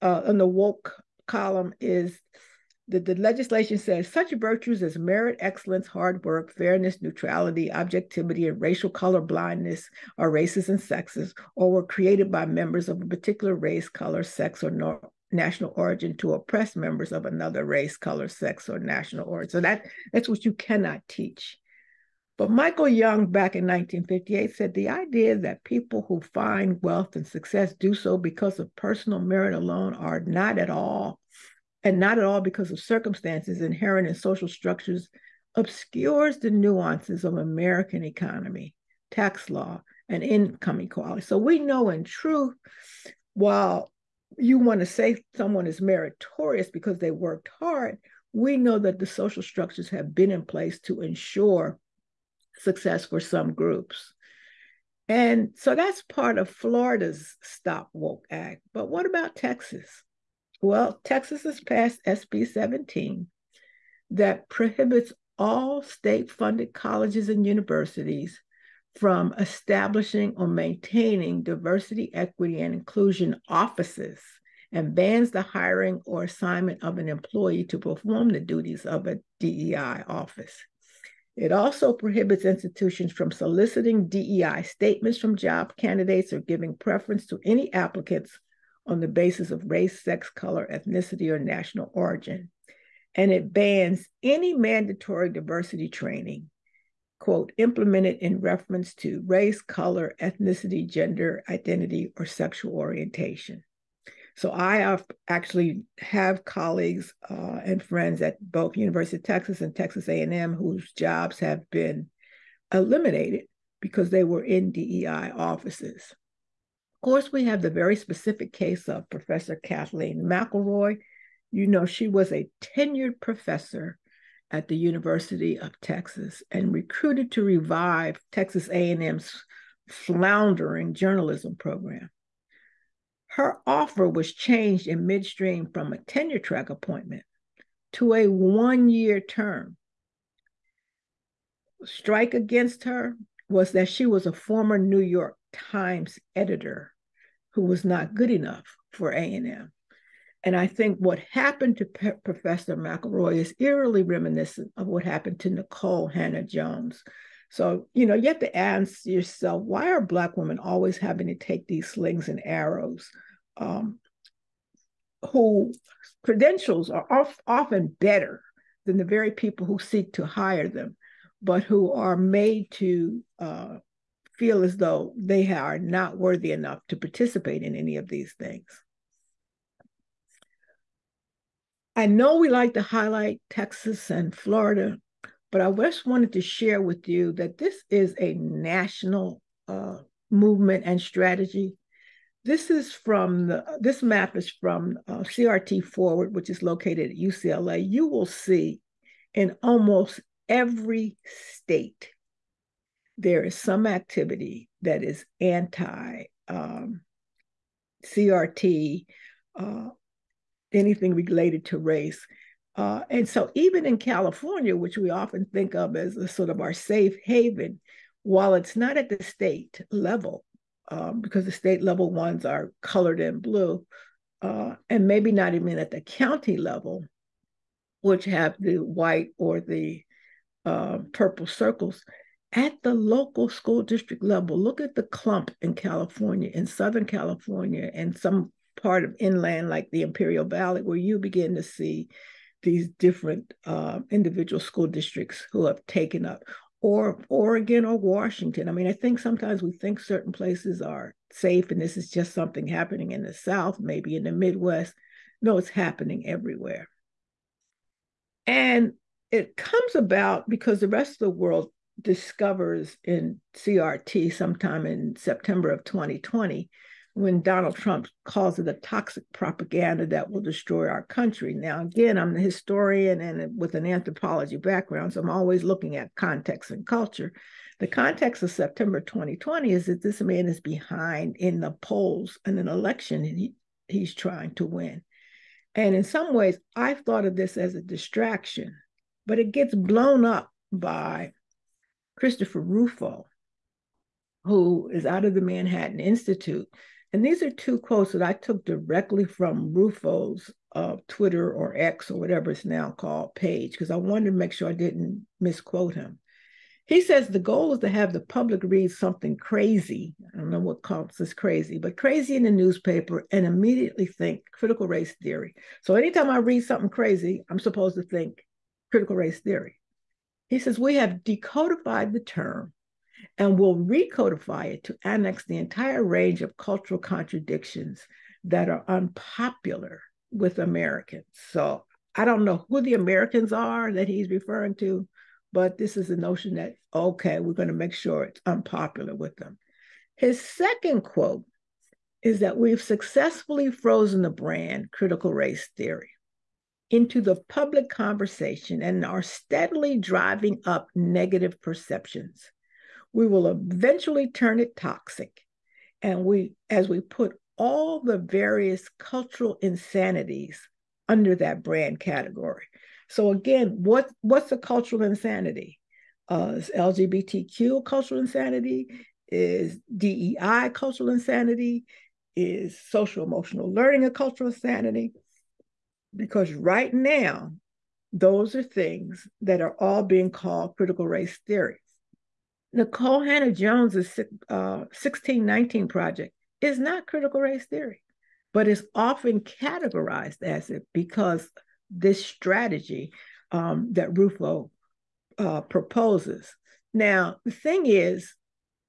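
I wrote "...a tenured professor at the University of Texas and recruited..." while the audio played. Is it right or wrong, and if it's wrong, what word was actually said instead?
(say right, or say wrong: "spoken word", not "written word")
right.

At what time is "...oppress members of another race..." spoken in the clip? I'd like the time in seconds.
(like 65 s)
16 s.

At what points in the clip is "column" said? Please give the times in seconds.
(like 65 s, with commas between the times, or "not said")
1 s.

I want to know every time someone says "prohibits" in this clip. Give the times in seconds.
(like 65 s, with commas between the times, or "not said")
64 s, 81 s.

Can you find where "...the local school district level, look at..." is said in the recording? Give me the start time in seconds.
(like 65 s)
232 s.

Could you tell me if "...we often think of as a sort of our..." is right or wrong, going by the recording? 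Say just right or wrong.
right.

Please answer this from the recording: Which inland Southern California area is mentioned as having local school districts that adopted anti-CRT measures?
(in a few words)
Imperial Valley.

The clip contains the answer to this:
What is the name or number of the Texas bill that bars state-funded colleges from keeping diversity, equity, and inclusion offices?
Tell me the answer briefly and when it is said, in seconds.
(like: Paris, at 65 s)
SB 17, at 62 s.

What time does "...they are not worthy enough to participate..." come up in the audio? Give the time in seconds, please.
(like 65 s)
175 s.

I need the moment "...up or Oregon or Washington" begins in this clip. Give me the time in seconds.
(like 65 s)
246 s.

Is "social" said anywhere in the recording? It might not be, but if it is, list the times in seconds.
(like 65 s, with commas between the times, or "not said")
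34 s, 49 s, 372 s.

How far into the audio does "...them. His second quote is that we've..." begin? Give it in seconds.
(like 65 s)
339 s.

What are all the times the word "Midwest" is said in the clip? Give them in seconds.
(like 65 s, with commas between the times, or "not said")
254 s.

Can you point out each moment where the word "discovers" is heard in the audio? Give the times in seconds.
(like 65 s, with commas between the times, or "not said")
262 s.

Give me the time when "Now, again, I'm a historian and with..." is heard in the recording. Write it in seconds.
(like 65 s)
271 s.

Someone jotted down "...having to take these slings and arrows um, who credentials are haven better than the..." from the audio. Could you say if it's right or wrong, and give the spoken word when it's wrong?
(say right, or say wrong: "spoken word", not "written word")
wrong: "often", not "haven".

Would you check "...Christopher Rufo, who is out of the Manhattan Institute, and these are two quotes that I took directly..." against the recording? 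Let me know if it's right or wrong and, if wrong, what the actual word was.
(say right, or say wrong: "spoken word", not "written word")
right.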